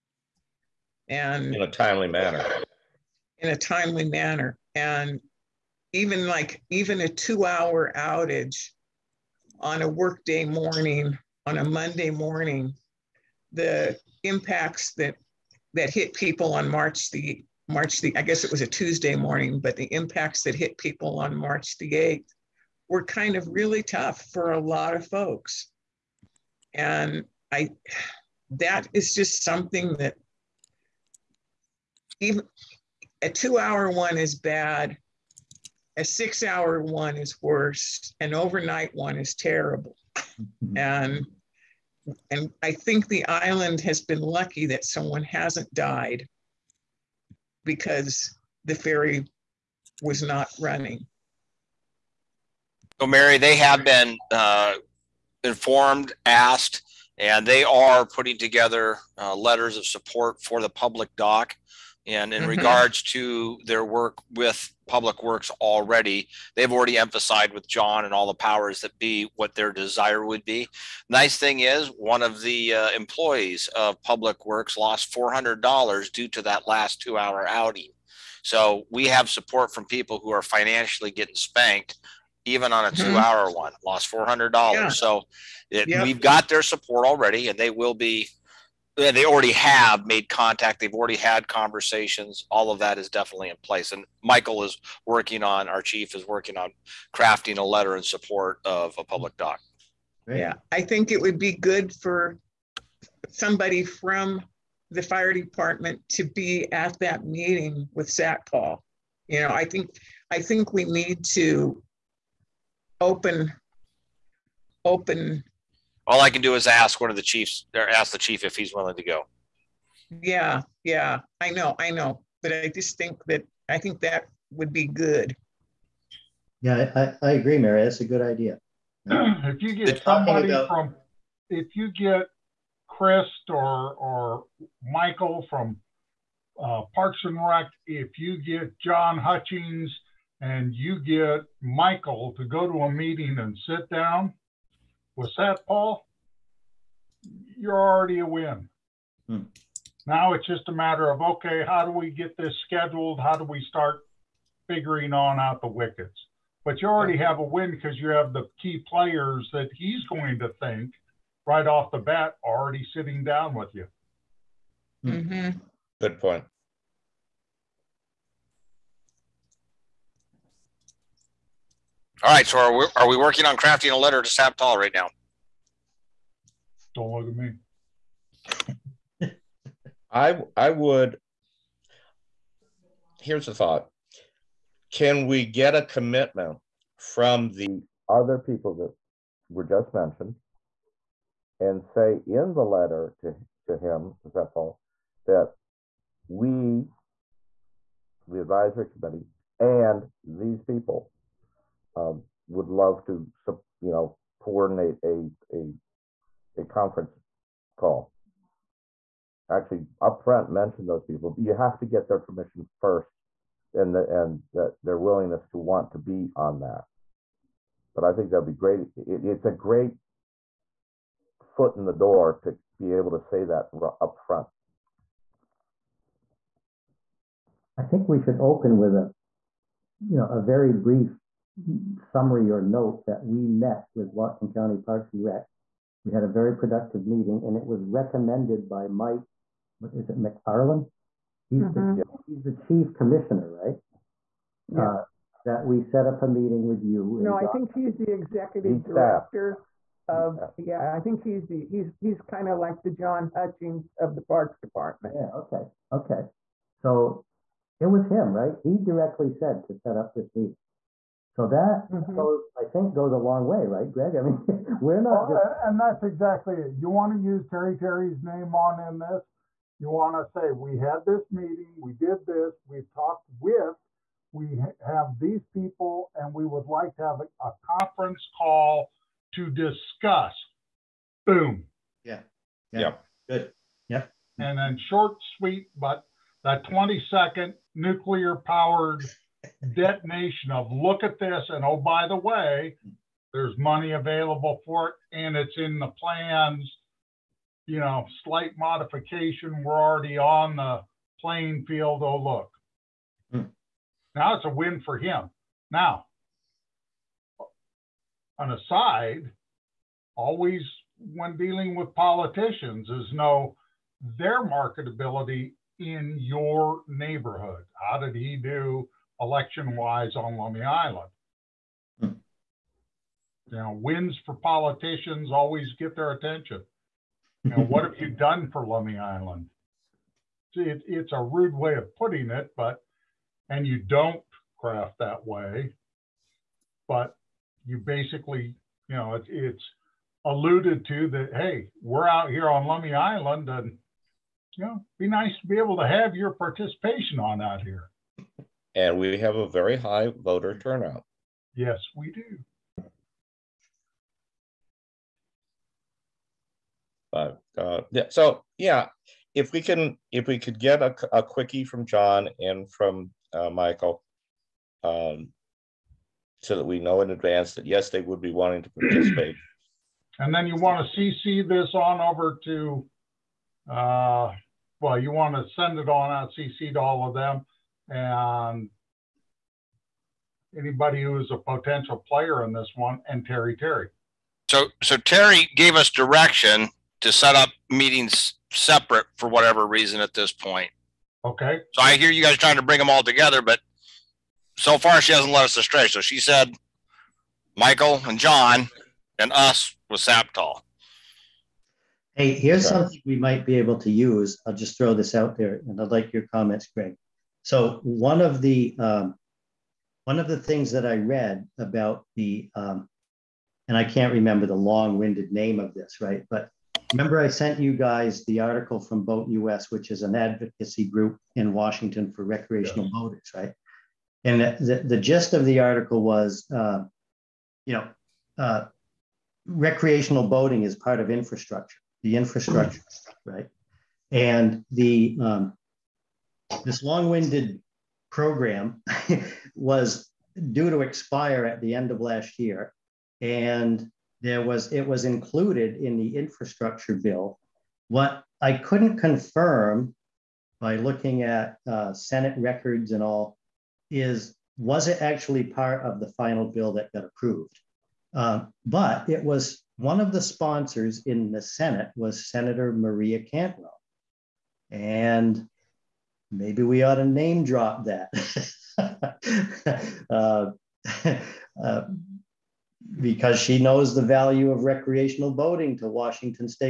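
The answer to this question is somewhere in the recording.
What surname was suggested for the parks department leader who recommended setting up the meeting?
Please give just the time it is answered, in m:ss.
4:00.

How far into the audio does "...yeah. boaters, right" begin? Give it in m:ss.
7:02.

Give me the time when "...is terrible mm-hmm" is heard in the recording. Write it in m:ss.
0:39.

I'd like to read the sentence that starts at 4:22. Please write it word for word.
goes, I think, goes a long way, right, Greg?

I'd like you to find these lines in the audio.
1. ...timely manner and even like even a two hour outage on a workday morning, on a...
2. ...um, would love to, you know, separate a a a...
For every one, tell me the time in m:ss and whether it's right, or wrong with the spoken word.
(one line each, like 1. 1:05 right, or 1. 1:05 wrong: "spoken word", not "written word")
1. 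0:03 right
2. 3:21 wrong: "coordinate", not "separate".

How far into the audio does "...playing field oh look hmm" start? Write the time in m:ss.
5:01.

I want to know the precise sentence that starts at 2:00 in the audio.
Yeah, yeah, I know, I know, but I just think that I think that would be good.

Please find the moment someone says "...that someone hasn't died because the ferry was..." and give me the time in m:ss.
0:44.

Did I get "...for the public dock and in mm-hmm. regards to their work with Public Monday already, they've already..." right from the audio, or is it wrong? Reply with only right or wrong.
wrong.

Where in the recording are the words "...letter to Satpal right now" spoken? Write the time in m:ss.
2:53.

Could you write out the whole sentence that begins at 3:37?
But I think that'd be great.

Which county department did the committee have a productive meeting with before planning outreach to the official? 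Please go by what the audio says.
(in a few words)
Whatcom County Parks and Rec.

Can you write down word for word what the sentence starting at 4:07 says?
No, I think he's the executive he's director.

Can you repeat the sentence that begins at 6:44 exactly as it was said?
I'll just throw this out there and I'd like your comments, Greg.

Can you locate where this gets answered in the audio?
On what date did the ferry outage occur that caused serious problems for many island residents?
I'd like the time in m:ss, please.
0:21.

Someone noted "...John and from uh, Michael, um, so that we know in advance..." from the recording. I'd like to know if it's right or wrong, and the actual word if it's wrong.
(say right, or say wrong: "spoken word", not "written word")
right.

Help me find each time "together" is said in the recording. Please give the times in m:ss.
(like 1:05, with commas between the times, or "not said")
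0:58, 6:33.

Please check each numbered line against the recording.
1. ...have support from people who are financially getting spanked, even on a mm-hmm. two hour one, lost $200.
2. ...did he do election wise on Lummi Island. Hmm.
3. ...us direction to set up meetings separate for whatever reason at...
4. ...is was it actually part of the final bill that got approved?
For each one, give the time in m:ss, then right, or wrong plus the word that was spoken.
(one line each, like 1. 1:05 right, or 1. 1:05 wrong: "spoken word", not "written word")
1. 1:19 wrong: "400", not "200"
2. 5:17 right
3. 6:25 right
4. 7:33 right.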